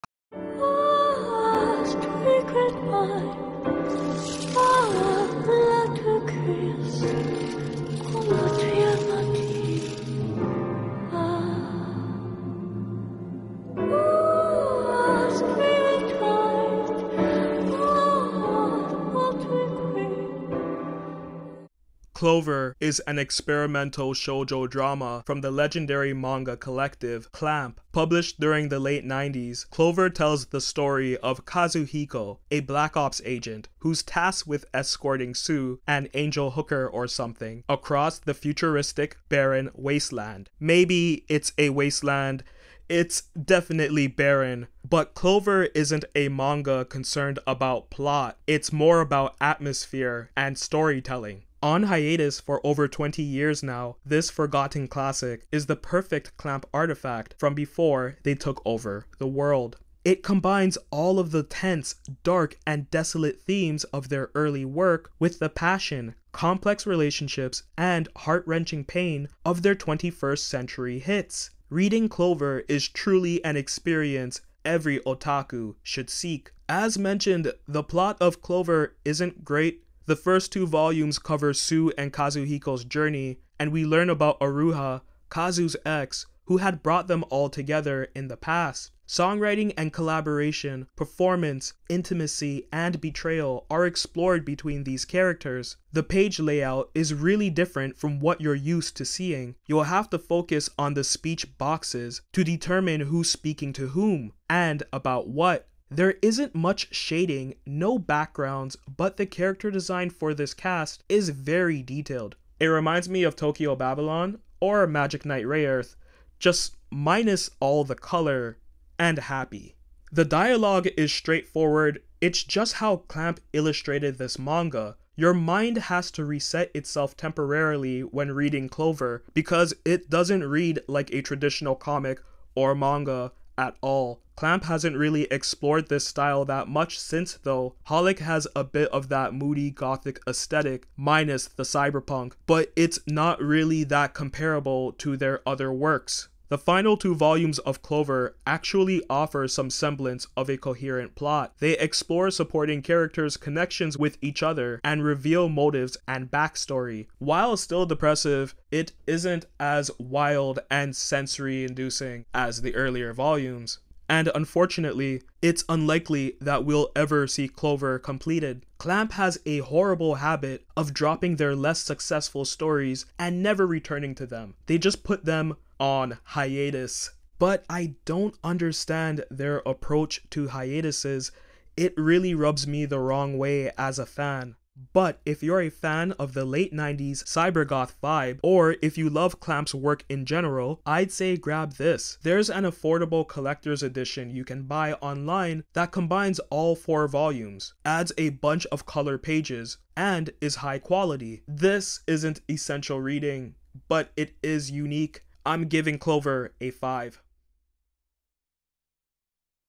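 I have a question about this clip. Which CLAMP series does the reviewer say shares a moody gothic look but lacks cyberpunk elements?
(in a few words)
Holic.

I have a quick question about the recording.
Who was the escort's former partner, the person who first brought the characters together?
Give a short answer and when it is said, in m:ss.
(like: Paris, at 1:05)
Aruha, at 1:24.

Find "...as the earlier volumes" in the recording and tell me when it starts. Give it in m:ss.
2:42.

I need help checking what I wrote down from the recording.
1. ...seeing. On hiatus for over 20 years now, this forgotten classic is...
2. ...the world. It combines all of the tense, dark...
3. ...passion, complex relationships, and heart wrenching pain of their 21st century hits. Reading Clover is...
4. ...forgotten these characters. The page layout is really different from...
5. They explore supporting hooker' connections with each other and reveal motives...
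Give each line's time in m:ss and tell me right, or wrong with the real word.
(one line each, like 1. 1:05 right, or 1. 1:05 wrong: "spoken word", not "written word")
1. 0:50 wrong: "storytelling", not "seeing"
2. 0:59 right
3. 1:05 right
4. 1:34 wrong: "between", not "forgotten"
5. 2:31 wrong: "characters", not "hooker".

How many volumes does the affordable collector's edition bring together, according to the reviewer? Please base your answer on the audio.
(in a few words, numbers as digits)
4.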